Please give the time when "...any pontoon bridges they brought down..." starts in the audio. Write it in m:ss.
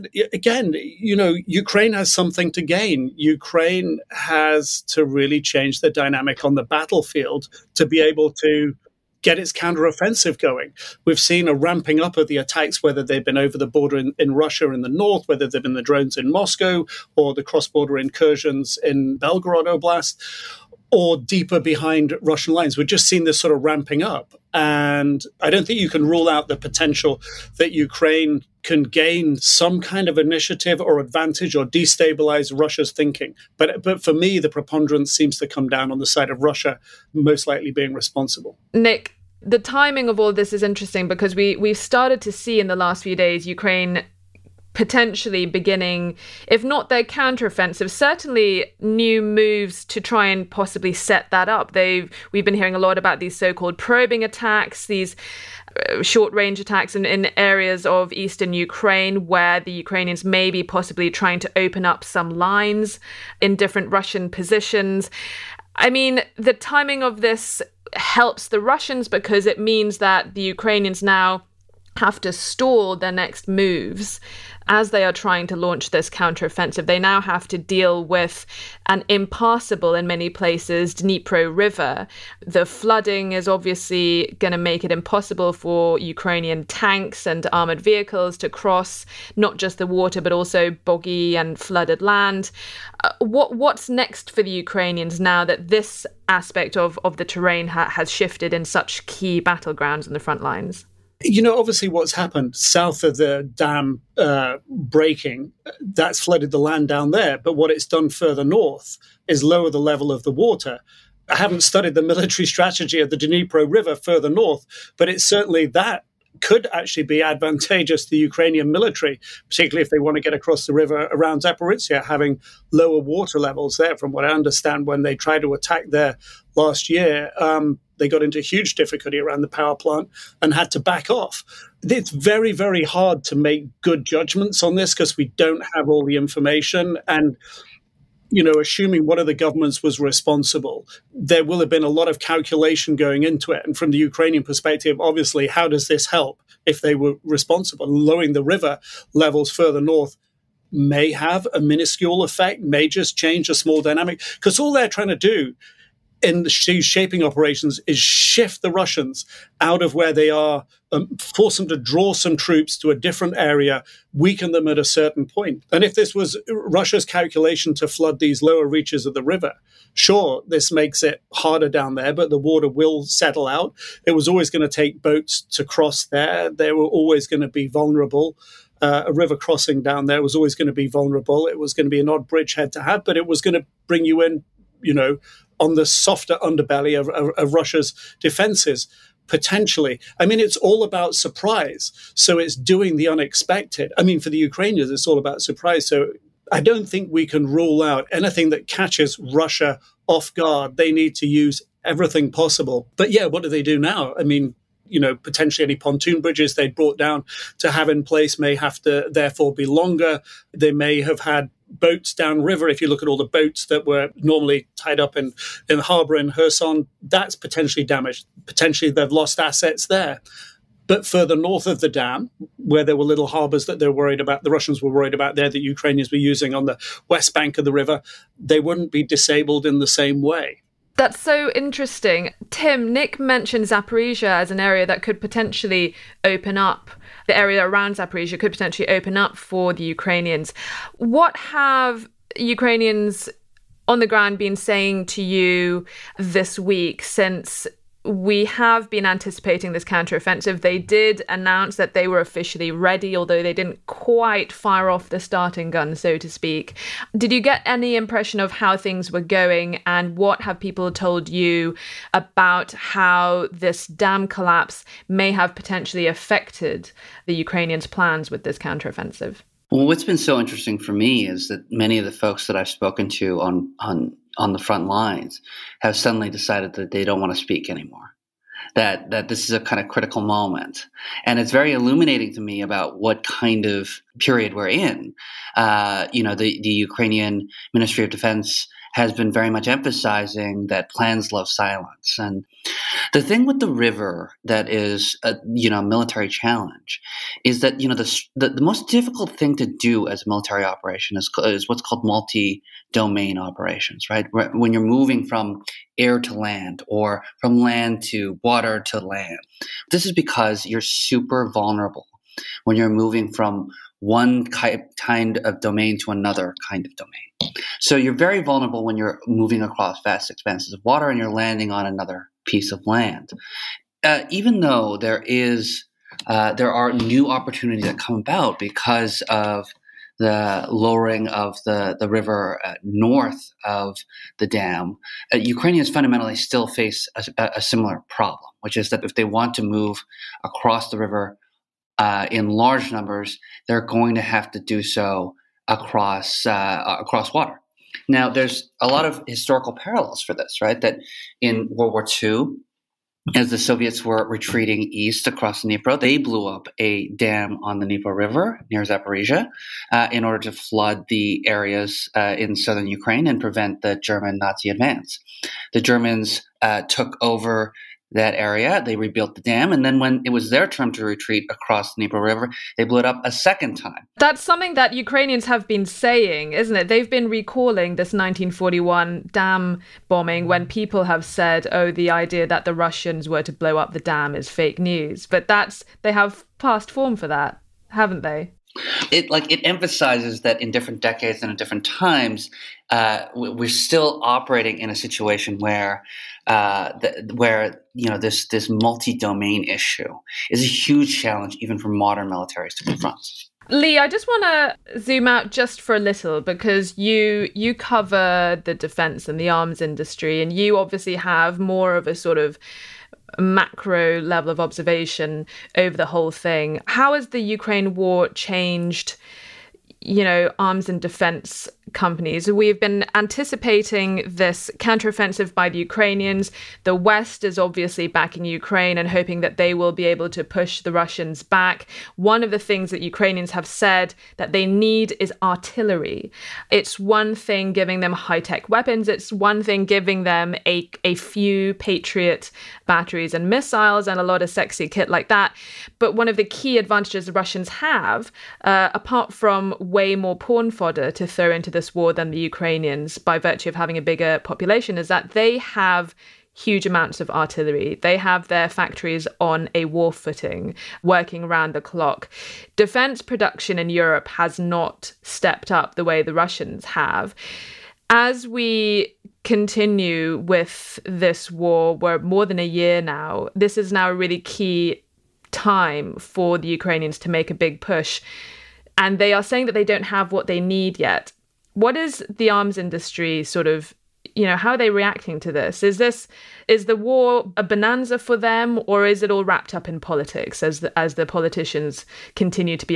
3:25.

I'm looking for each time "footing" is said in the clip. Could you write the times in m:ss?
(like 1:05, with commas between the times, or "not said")
7:40.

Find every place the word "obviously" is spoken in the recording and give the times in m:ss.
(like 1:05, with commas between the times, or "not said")
1:23, 1:41, 2:25, 6:50, 7:07.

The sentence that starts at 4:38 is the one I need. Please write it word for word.
That that this is a kind of critical moment, and it's very illuminating to me about what kind of period we're in.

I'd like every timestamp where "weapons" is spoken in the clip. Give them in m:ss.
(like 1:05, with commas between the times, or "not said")
7:18.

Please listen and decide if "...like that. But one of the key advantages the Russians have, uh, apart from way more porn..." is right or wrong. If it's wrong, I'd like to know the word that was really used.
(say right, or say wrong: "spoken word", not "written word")
right.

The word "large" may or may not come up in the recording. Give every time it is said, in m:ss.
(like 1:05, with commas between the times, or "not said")
5:42.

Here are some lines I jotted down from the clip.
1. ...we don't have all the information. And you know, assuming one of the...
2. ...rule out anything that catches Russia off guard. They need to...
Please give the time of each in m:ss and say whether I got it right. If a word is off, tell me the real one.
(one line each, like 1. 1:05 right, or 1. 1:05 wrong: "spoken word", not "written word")
1. 2:15 right
2. 3:17 right.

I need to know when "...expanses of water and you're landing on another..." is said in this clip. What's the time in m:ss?
5:20.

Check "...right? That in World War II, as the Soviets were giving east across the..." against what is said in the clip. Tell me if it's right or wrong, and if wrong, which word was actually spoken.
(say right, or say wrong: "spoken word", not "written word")
wrong: "retreating", not "giving".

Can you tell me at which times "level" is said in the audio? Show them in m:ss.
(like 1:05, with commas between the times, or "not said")
1:49, 2:03, 2:29, 6:54.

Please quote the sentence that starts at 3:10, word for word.
I mean, it's all about surprise.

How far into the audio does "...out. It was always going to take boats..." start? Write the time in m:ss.
2:53.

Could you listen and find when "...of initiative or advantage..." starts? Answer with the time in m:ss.
0:30.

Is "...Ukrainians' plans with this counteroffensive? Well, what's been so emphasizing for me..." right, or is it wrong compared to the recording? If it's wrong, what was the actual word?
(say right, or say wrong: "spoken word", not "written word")
wrong: "interesting", not "emphasizing".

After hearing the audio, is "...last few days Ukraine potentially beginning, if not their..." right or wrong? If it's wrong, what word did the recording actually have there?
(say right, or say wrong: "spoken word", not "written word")
right.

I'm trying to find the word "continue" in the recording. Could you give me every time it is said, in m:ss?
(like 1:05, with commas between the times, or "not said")
7:49, 8:12.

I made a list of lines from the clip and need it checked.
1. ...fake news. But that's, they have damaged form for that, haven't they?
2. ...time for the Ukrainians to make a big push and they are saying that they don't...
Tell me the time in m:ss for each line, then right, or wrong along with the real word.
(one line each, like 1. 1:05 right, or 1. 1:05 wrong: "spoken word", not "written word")
1. 6:24 wrong: "passed", not "damaged"
2. 7:55 right.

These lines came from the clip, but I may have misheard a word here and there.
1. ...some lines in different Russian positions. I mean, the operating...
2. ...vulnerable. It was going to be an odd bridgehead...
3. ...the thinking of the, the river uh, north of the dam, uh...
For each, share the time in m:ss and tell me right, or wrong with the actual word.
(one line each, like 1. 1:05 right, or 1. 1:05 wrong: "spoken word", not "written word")
1. 1:02 wrong: "timing", not "operating"
2. 3:00 right
3. 5:30 wrong: "lowering", not "thinking".